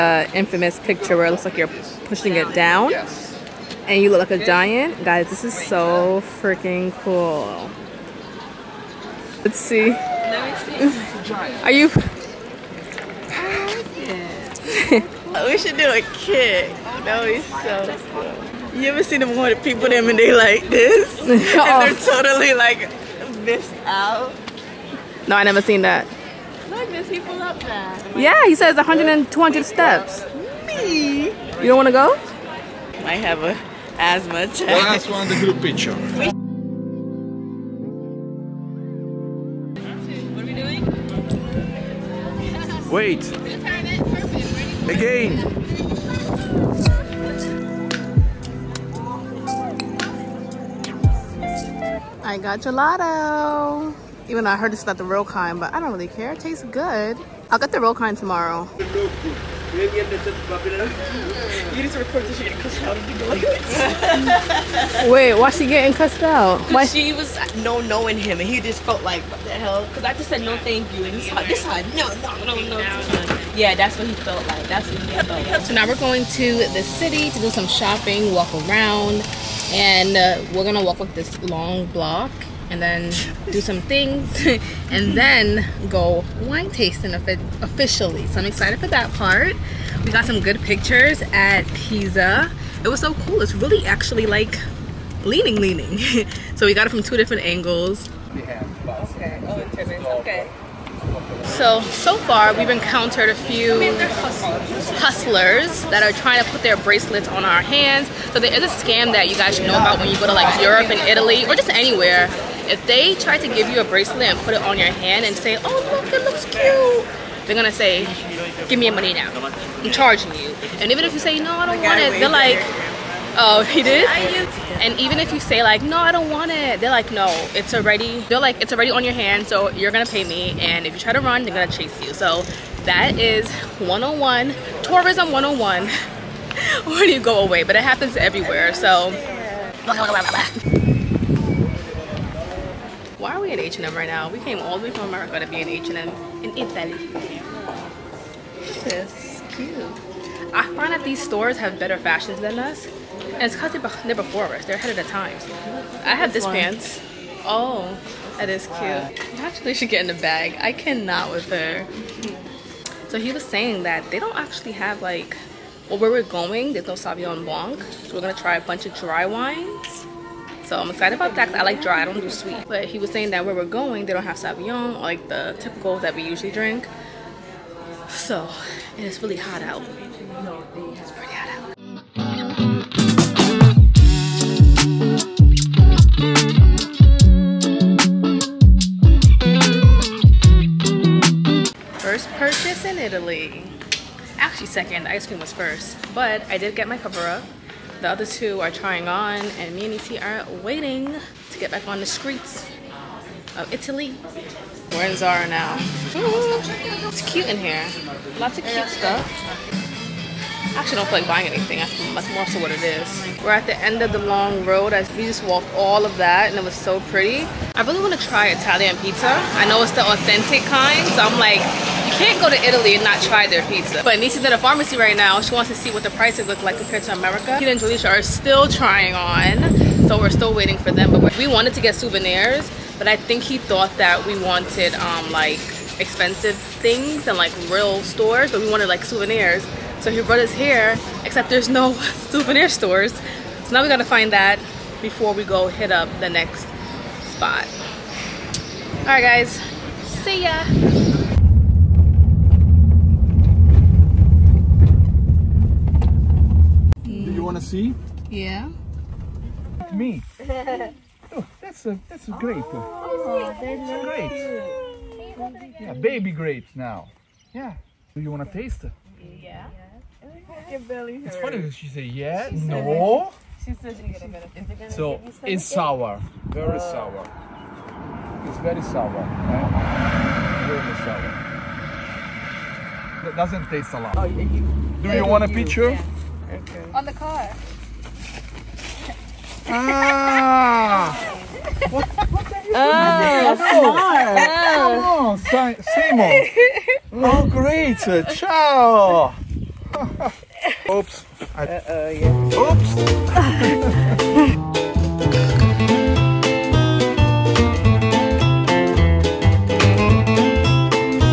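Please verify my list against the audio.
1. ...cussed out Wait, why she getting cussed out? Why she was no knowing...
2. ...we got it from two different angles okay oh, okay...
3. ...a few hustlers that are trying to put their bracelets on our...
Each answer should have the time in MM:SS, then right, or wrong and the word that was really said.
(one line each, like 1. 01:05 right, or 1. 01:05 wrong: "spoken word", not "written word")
1. 01:02 right
2. 01:36 right
3. 01:43 right.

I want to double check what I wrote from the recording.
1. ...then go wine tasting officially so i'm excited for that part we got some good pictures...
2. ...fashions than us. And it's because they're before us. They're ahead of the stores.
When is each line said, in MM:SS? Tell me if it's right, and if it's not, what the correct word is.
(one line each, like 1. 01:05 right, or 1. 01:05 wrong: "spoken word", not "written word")
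1. 01:25 right
2. 02:31 wrong: "times", not "stores".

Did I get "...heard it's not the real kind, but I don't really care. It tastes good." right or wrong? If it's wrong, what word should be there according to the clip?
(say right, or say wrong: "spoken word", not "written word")
right.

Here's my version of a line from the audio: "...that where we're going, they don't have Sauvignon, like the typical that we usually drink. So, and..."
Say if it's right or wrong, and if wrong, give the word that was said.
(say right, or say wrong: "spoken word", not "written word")
right.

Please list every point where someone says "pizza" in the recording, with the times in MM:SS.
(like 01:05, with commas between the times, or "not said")
03:38, 03:43.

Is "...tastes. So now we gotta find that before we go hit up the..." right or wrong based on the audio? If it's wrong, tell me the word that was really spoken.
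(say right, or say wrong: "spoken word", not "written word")
wrong: "stores", not "tastes".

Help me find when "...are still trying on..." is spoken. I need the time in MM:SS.
03:48.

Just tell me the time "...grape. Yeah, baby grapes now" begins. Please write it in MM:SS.
04:25.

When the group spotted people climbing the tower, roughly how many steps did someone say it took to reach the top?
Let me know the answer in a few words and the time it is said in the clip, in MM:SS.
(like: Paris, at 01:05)
100 and 200, at 00:28.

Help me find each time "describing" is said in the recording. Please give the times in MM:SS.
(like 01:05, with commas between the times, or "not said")
not said.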